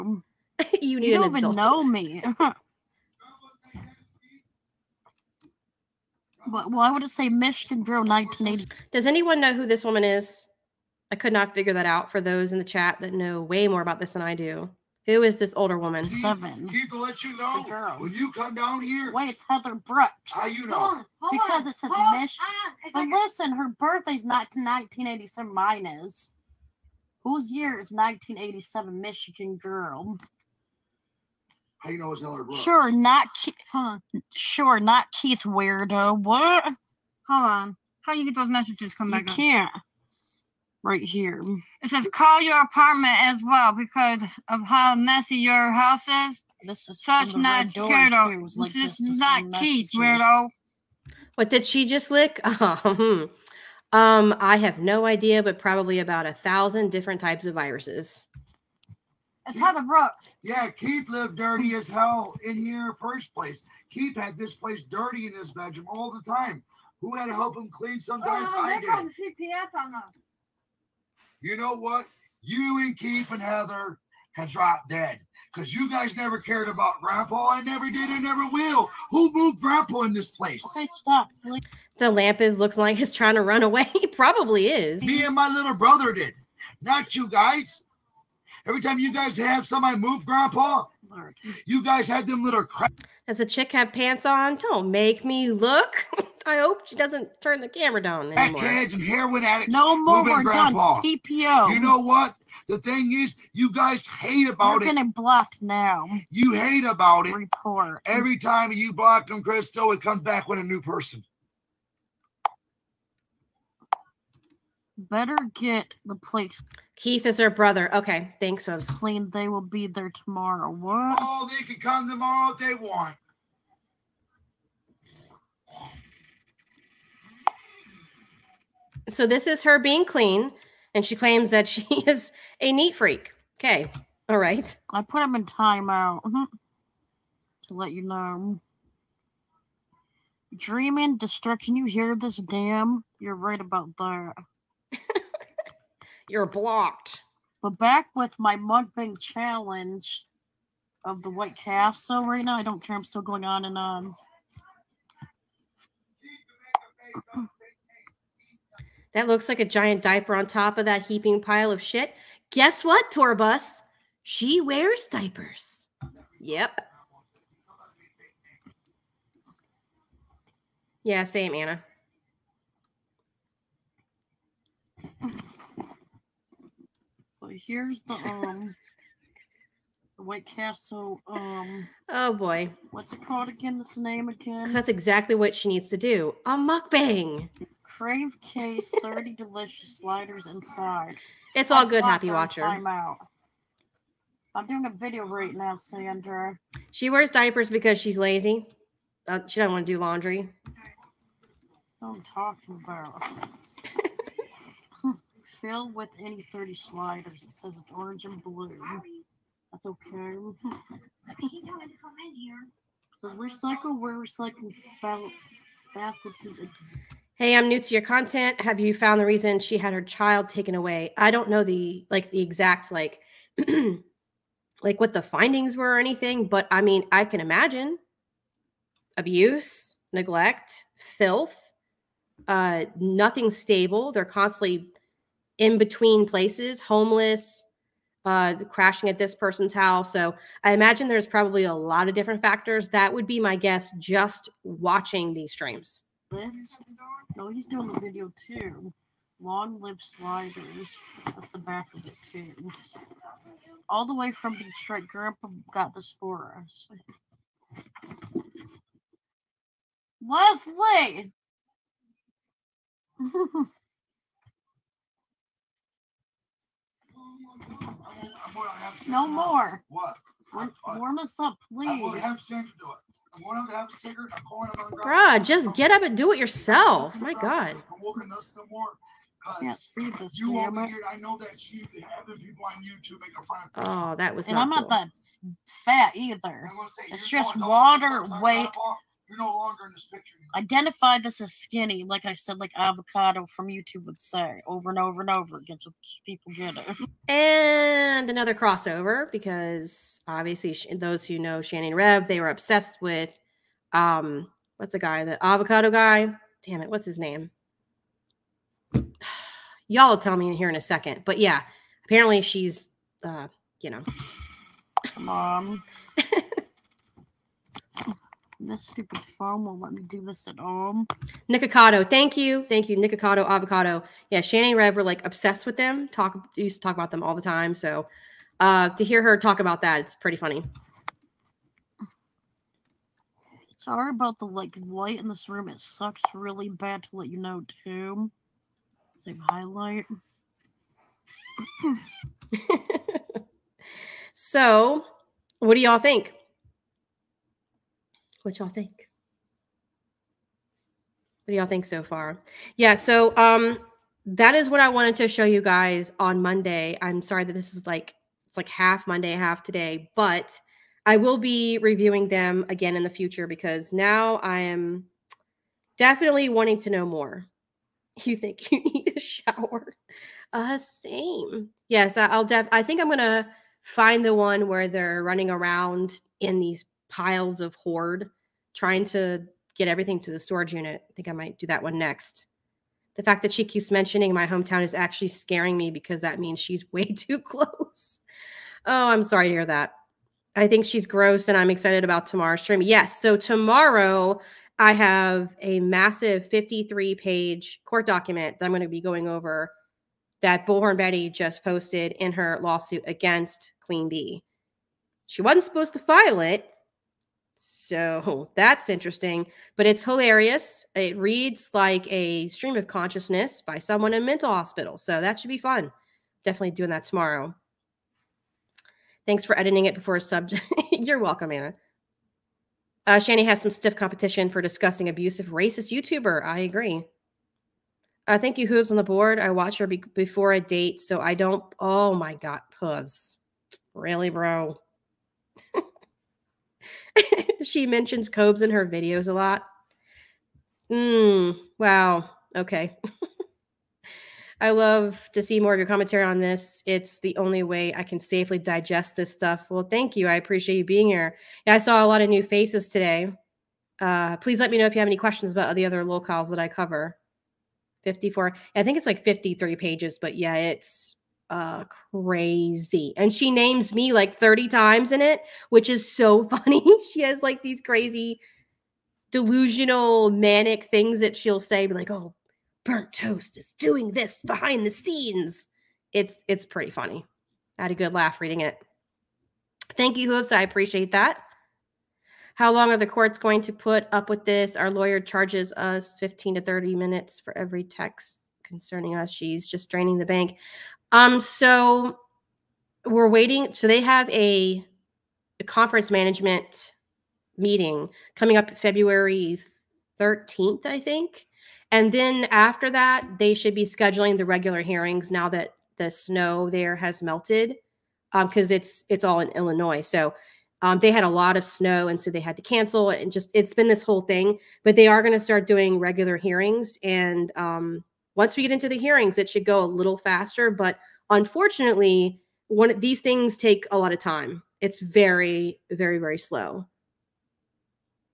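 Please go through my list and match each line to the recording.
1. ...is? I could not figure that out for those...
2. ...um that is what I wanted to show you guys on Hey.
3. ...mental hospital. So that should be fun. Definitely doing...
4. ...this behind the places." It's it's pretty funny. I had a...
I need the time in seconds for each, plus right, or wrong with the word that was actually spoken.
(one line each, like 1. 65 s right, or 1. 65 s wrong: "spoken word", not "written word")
1. 10 s right
2. 353 s wrong: "Monday", not "Hey"
3. 414 s right
4. 474 s wrong: "scenes", not "places".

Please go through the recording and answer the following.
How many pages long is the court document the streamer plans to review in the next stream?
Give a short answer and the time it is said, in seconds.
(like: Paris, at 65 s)
53, at 396 s.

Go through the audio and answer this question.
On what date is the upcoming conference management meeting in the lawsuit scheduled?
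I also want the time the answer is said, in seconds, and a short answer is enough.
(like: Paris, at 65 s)
February 13th, at 498 s.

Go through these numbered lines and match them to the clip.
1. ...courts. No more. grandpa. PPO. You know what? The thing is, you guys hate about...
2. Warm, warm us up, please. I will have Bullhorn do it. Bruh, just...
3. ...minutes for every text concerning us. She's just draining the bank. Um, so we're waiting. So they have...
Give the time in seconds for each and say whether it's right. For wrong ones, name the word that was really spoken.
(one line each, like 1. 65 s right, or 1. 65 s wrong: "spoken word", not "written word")
1. 99 s wrong: "addicts", not "courts"
2. 270 s wrong: "Santa", not "Bullhorn"
3. 486 s right.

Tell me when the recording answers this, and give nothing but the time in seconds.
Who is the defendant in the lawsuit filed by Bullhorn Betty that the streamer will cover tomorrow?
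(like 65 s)
403 s.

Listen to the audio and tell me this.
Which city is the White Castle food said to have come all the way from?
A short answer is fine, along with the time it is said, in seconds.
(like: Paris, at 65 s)
Detroit, at 253 s.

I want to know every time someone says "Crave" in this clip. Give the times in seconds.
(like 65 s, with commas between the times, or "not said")
187 s.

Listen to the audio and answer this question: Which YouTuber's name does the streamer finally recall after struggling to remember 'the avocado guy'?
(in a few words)
Nikocado Avocado.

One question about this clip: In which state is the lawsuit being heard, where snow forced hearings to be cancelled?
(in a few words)
Illinois.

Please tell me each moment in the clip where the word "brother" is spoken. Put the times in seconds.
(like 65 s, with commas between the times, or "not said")
85 s, 117 s.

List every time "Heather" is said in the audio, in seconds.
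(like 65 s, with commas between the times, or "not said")
19 s, 73 s.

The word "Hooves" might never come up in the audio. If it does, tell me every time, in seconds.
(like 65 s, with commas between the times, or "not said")
428 s, 432 s.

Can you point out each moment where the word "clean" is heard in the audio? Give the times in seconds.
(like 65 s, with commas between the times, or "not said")
67 s, 118 s, 130 s.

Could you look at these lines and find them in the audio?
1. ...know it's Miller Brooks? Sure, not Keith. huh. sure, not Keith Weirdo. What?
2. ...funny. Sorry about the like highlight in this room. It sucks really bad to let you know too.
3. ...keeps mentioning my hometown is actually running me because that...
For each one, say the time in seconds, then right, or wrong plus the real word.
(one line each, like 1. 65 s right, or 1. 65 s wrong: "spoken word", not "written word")
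1. 31 s right
2. 330 s wrong: "light", not "highlight"
3. 383 s wrong: "scaring", not "running".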